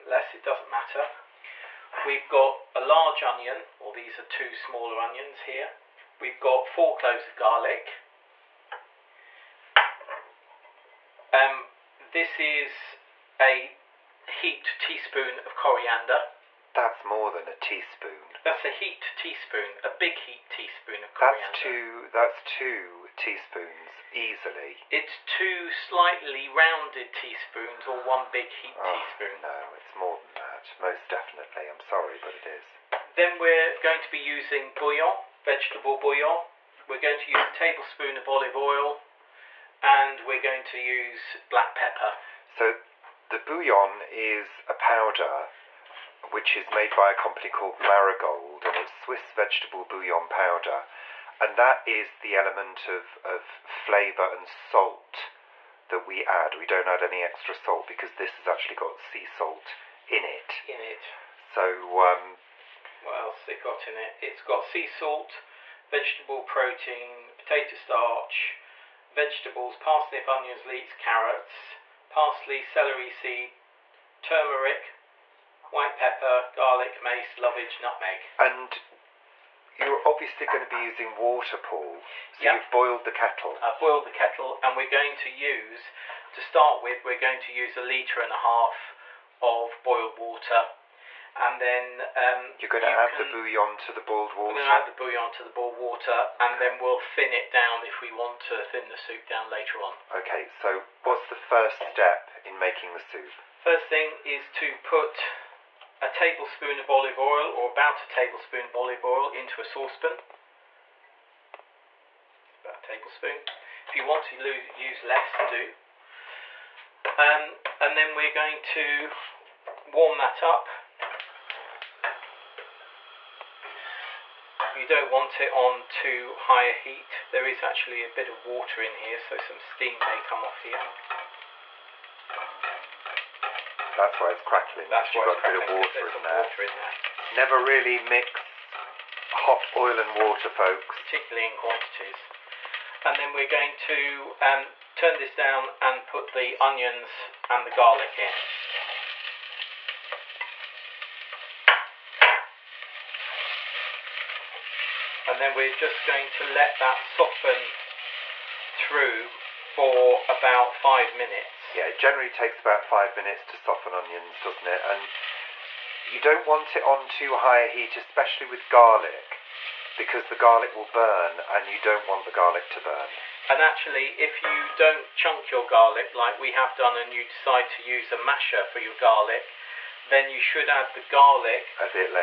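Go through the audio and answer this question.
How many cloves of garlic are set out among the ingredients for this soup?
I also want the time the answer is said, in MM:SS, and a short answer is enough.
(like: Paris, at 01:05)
4, at 00:06.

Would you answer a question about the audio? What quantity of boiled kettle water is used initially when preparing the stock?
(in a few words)
1.5 litres.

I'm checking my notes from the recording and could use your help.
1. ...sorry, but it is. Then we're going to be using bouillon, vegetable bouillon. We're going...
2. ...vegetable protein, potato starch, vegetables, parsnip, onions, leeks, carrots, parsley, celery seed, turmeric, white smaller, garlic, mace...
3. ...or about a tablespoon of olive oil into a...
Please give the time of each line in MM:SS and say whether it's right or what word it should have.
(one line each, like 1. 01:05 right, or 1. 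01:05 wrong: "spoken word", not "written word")
1. 00:31 right
2. 01:05 wrong: "pepper", not "smaller"
3. 01:47 right.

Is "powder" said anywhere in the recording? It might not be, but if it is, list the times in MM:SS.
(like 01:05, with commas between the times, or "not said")
00:44, 00:50.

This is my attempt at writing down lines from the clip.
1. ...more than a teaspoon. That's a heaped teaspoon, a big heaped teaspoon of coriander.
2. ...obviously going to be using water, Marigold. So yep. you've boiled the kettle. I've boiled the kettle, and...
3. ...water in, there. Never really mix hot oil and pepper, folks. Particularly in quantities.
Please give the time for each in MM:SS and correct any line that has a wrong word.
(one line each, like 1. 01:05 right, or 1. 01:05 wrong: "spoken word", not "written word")
1. 00:17 right
2. 01:20 wrong: "Paul", not "Marigold"
3. 02:16 wrong: "water", not "pepper".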